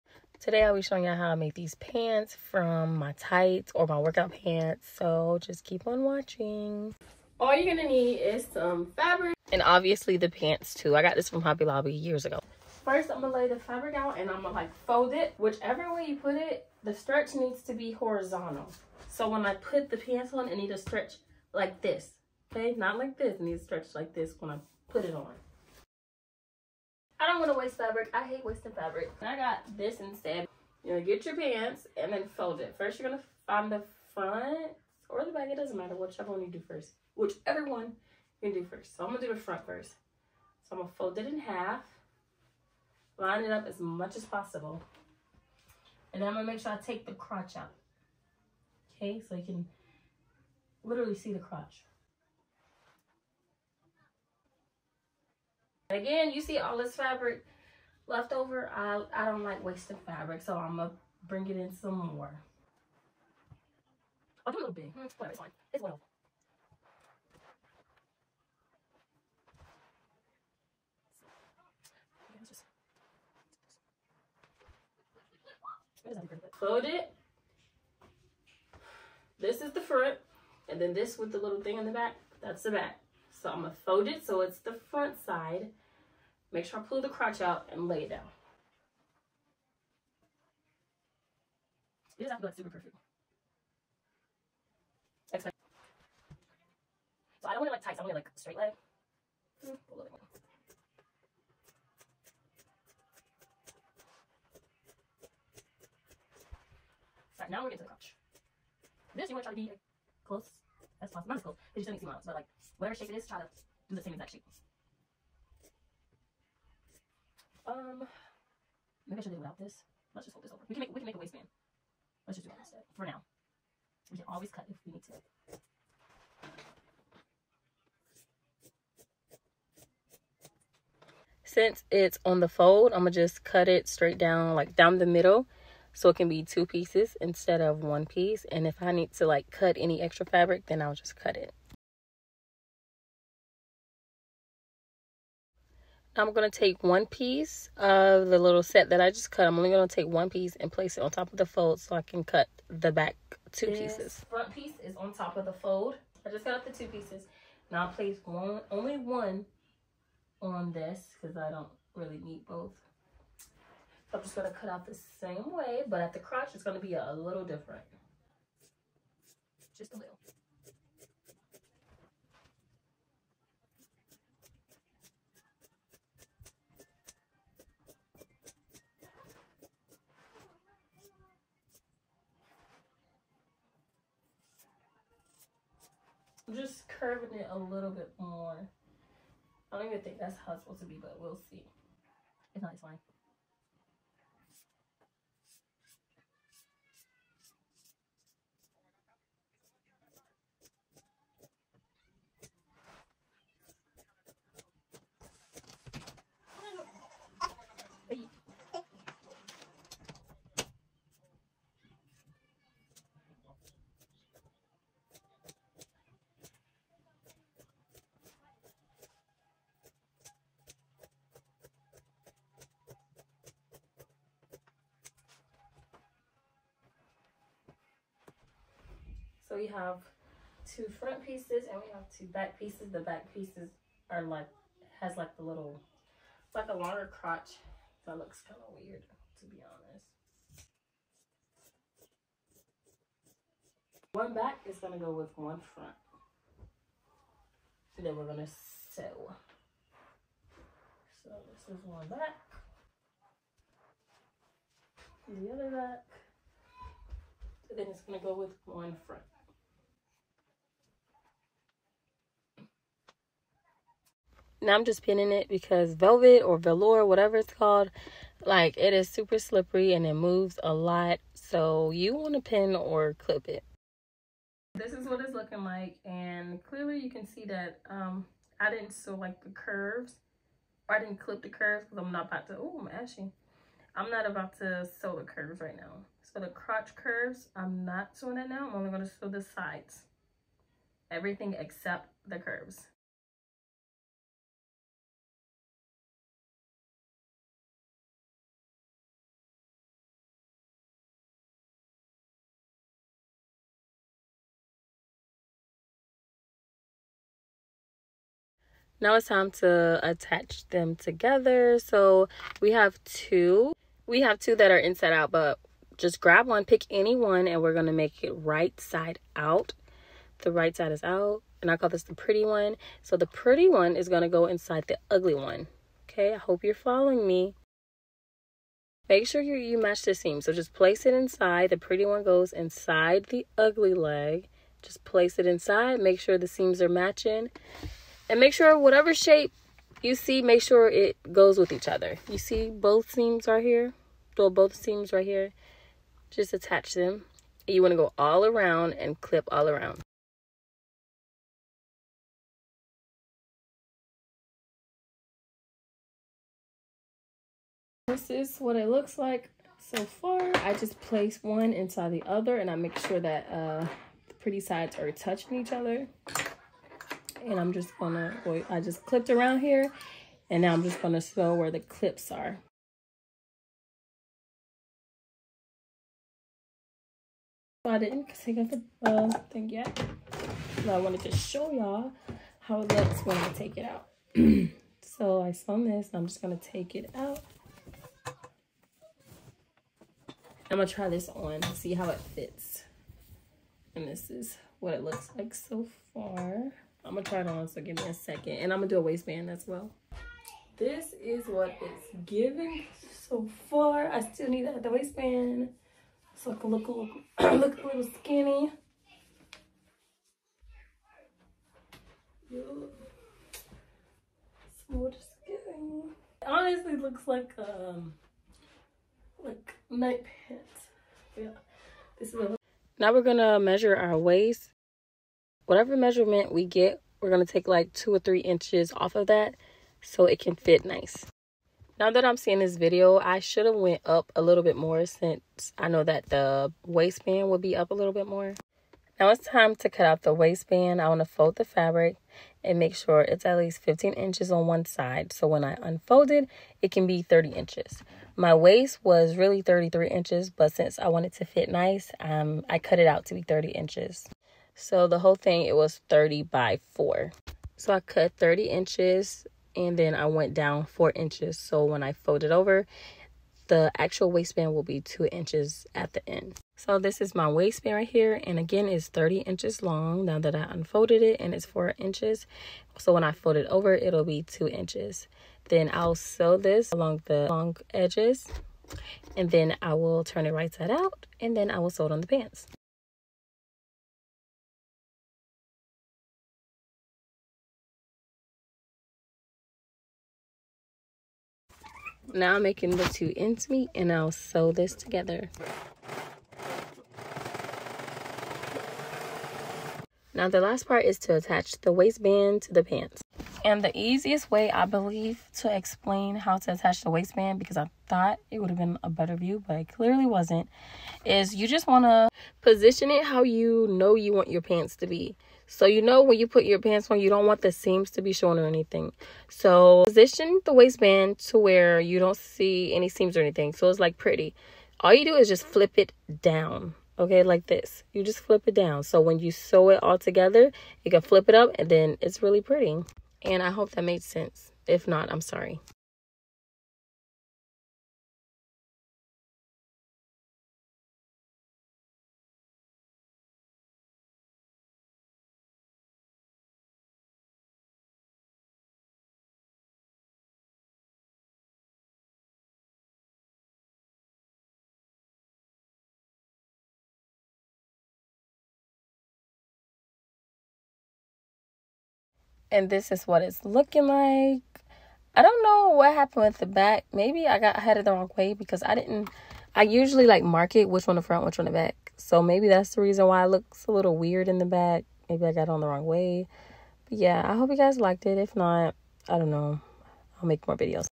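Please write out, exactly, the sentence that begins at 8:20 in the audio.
Now the last part is to attach the waistband to the pants.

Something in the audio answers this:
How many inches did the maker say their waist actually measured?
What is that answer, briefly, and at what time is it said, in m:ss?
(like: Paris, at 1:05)
33, at 7:29.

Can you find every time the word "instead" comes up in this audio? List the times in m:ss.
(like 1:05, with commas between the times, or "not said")
0:29, 2:02, 2:17.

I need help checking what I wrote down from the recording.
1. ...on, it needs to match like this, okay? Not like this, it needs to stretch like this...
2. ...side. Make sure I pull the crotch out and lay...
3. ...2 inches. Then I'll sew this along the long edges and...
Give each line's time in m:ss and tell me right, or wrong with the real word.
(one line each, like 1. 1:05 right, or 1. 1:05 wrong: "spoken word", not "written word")
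1. 0:20 wrong: "stretch", not "match"
2. 1:25 right
3. 7:54 right.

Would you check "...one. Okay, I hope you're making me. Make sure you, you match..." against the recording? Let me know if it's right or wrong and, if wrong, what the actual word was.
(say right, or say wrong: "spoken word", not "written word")
wrong: "following", not "making".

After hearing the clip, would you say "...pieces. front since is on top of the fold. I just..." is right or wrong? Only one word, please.
wrong.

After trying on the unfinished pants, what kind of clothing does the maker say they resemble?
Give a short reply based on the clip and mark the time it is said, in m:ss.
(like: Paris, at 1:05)
Night pants, at 6:59.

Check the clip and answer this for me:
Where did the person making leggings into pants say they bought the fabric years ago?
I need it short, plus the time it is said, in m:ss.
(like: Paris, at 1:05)
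Hobby Lobby, at 0:11.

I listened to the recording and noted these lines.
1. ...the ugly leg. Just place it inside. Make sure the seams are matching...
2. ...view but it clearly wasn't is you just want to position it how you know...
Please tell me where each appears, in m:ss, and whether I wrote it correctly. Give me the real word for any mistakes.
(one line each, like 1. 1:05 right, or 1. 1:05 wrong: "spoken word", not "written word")
1. 5:33 right
2. 8:29 right.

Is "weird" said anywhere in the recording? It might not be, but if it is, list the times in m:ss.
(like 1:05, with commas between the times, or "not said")
3:58, 9:34.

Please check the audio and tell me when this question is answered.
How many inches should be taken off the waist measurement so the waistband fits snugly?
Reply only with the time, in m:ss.
7:07.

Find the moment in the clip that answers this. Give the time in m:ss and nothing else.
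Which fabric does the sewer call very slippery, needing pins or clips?
4:25.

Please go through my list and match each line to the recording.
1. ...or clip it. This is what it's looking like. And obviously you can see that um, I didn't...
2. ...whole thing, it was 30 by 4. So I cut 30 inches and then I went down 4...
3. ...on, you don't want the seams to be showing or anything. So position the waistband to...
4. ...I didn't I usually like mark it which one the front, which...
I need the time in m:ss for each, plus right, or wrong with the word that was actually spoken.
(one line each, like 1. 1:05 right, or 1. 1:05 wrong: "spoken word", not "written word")
1. 4:32 wrong: "clearly", not "obviously"
2. 7:35 right
3. 8:37 right
4. 9:28 right.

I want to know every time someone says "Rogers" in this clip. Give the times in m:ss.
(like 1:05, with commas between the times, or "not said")
not said.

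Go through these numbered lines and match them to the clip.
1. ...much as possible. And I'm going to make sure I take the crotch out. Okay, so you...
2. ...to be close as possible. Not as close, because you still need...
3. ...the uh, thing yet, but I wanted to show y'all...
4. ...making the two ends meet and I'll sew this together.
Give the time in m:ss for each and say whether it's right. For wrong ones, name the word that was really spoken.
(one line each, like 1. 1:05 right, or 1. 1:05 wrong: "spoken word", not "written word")
1. 0:43 right
2. 1:49 right
3. 6:18 right
4. 8:12 right.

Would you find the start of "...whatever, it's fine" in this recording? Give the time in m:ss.
1:05.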